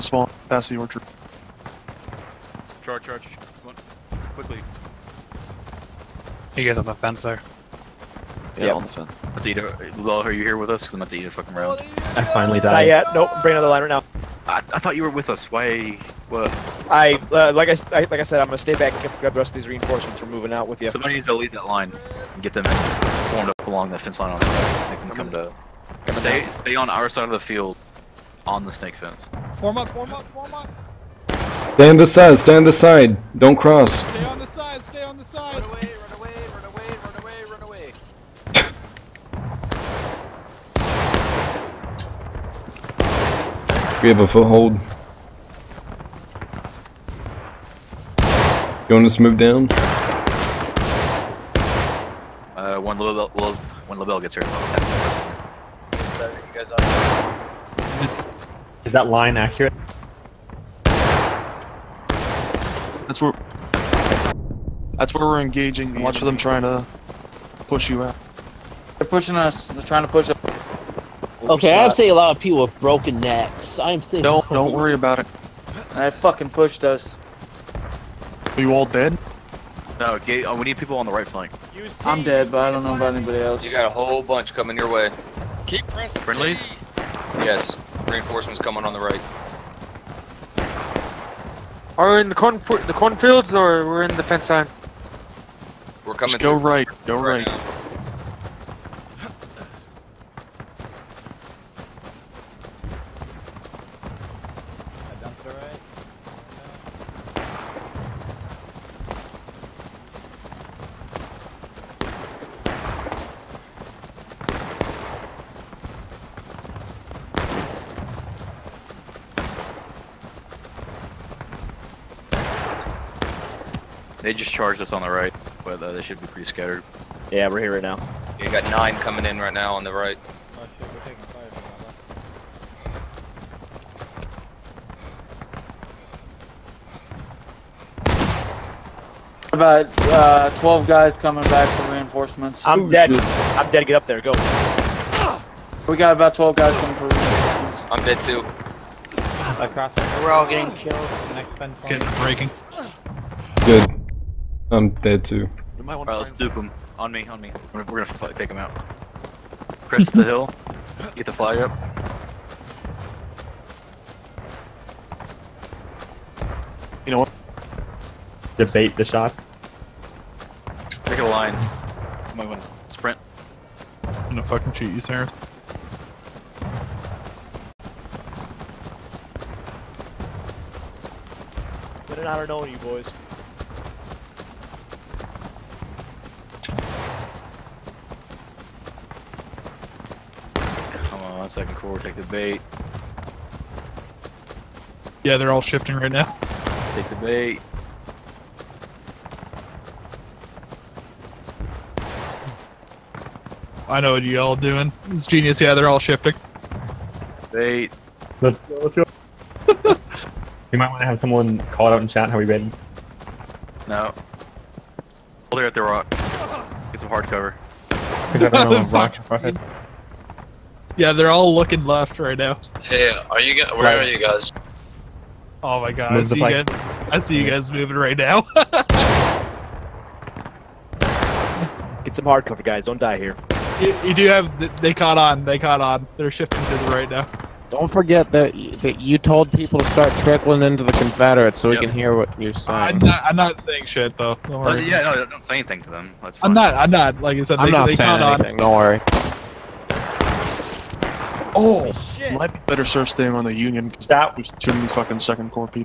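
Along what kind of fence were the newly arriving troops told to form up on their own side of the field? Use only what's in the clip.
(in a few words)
Snake fence.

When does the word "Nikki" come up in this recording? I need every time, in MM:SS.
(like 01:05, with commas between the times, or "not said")
not said.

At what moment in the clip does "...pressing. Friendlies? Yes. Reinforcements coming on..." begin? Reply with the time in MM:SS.
01:25.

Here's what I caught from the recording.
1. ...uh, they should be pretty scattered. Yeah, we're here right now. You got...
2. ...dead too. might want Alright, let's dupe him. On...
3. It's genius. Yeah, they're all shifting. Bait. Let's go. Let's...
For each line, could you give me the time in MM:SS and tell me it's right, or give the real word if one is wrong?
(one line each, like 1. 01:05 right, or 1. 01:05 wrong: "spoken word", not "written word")
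1. 02:05 right
2. 02:34 right
3. 03:25 right.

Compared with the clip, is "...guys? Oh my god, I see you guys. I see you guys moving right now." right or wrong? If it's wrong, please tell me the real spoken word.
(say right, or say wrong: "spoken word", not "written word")
right.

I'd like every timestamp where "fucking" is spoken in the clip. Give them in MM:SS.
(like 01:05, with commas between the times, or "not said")
00:11, 01:16, 02:54, 04:14.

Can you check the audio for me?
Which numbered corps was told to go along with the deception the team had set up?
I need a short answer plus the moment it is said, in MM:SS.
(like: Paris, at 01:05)
Second corps, at 03:11.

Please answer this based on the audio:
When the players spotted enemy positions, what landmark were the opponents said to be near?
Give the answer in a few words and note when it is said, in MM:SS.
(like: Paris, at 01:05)
The rock, at 03:35.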